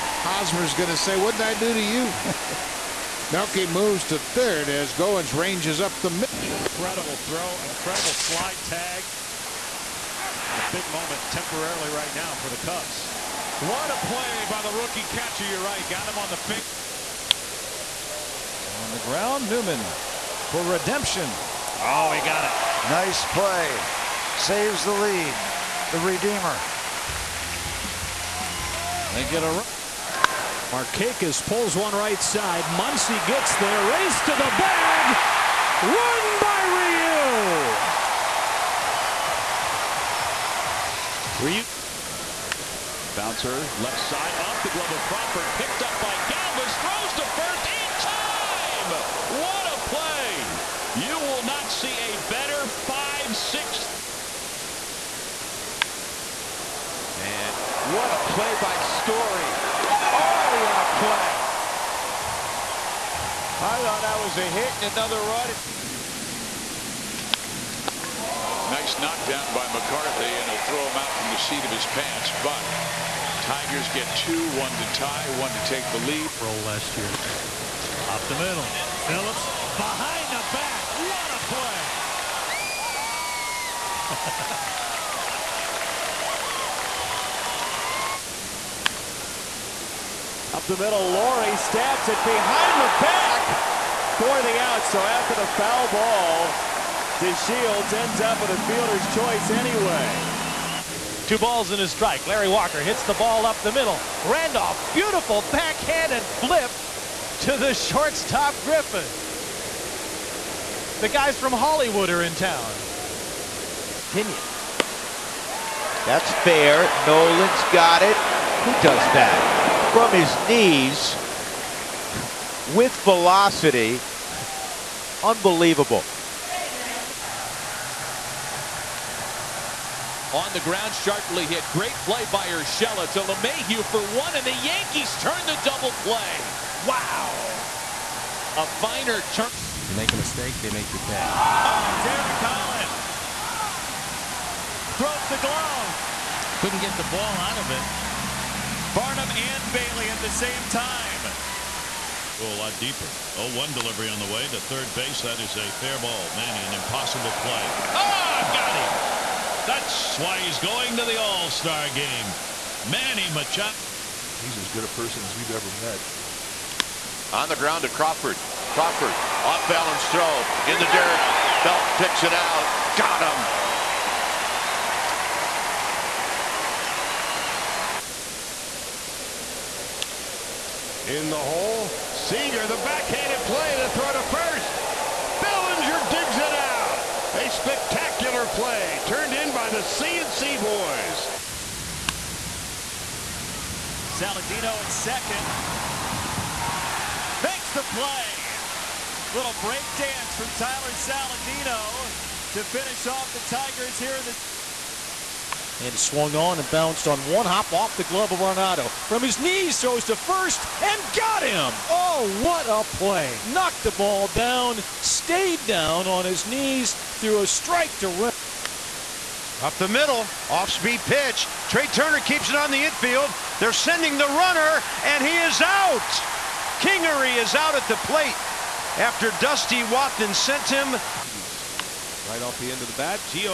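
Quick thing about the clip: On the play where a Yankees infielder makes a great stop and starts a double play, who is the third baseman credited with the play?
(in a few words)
Urshela.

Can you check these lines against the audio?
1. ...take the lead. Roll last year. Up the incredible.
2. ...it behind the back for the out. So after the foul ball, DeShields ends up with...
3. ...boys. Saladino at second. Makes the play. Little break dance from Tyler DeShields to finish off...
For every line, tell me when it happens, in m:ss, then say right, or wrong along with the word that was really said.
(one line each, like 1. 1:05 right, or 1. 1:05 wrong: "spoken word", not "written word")
1. 1:15 wrong: "middle", not "incredible"
2. 1:32 right
3. 3:10 wrong: "Saladino", not "DeShields".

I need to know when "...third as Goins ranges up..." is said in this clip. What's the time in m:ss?
0:04.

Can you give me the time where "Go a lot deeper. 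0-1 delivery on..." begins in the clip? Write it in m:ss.
2:32.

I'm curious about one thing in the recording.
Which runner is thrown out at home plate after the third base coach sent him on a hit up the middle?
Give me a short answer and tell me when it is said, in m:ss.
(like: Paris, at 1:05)
Kingery, at 3:46.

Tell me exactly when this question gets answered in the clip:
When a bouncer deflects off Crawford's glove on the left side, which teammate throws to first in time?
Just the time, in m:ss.
0:46.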